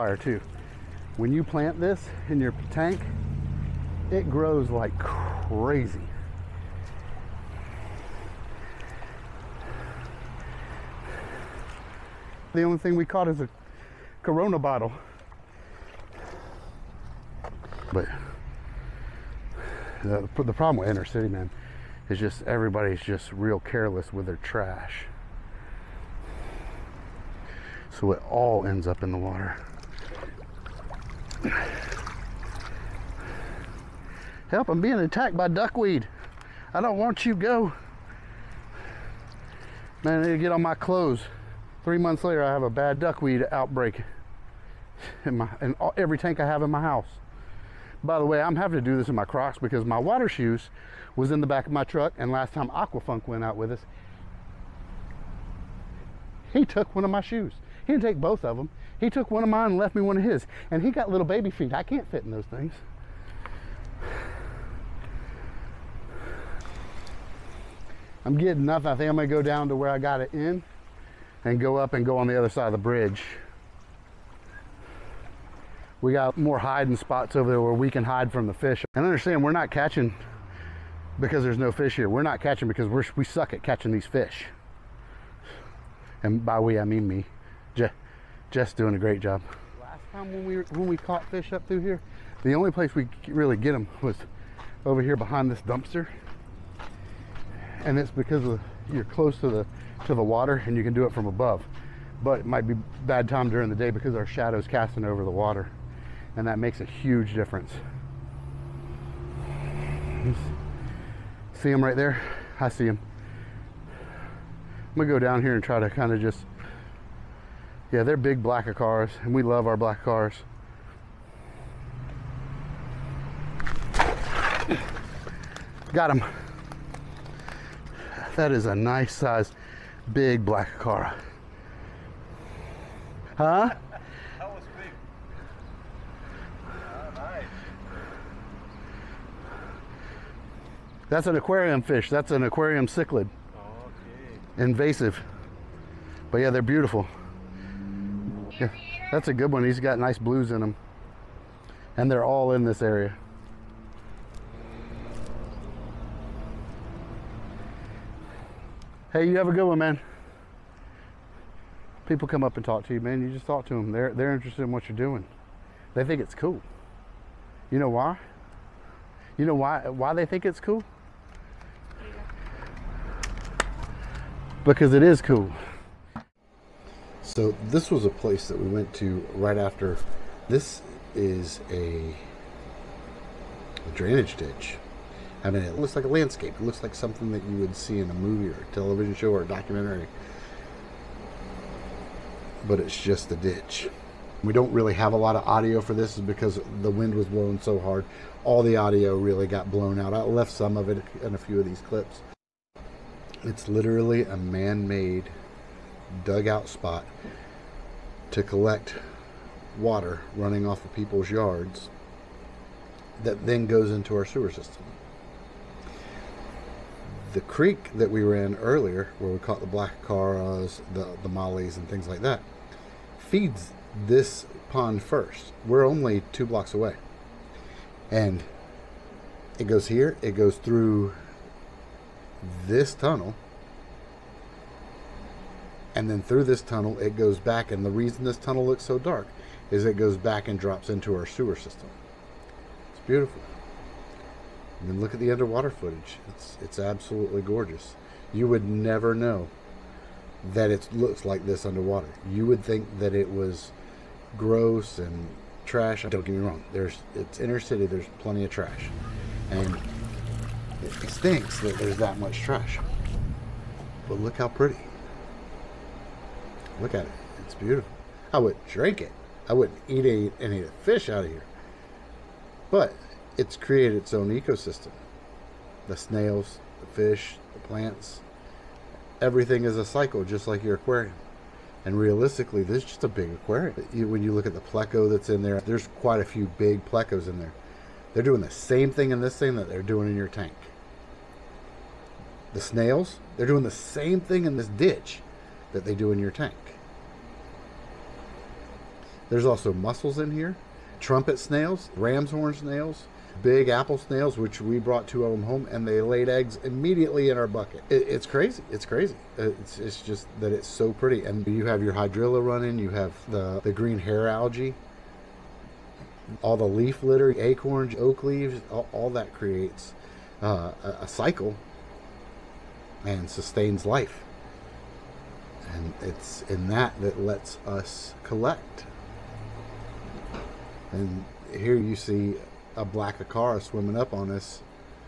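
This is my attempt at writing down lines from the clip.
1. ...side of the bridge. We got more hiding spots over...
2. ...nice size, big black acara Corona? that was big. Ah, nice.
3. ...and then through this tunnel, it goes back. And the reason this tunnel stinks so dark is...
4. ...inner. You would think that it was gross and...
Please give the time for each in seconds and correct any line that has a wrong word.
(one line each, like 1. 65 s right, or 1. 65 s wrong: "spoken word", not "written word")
1. 72 s right
2. 128 s wrong: "Huh", not "Corona"
3. 235 s wrong: "looks", not "stinks"
4. 251 s wrong: "underwater", not "inner".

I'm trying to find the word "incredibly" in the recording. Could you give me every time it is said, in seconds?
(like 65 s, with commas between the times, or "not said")
not said.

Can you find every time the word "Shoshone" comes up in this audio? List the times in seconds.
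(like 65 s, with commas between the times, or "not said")
not said.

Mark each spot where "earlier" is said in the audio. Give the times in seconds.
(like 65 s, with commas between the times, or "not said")
218 s.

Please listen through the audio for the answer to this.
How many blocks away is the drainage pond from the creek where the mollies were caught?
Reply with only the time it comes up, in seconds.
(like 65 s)
226 s.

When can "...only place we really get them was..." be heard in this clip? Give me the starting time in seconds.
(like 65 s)
92 s.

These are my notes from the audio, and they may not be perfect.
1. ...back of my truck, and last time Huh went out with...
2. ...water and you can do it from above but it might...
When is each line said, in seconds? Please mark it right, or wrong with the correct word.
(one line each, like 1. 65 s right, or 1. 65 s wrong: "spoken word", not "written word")
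1. 51 s wrong: "Aquafunk", not "Huh"
2. 100 s right.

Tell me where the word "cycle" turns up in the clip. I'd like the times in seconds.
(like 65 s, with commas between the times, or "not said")
279 s, 321 s.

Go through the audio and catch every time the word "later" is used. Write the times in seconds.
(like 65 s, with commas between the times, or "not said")
42 s.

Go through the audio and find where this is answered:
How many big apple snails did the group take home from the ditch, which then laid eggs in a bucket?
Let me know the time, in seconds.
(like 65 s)
305 s.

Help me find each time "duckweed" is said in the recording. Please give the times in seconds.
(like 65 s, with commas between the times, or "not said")
35 s, 42 s.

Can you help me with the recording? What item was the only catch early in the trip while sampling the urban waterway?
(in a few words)
A Corona bottle.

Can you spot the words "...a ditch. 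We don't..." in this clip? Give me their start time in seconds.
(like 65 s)
193 s.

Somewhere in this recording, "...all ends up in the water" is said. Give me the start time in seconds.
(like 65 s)
28 s.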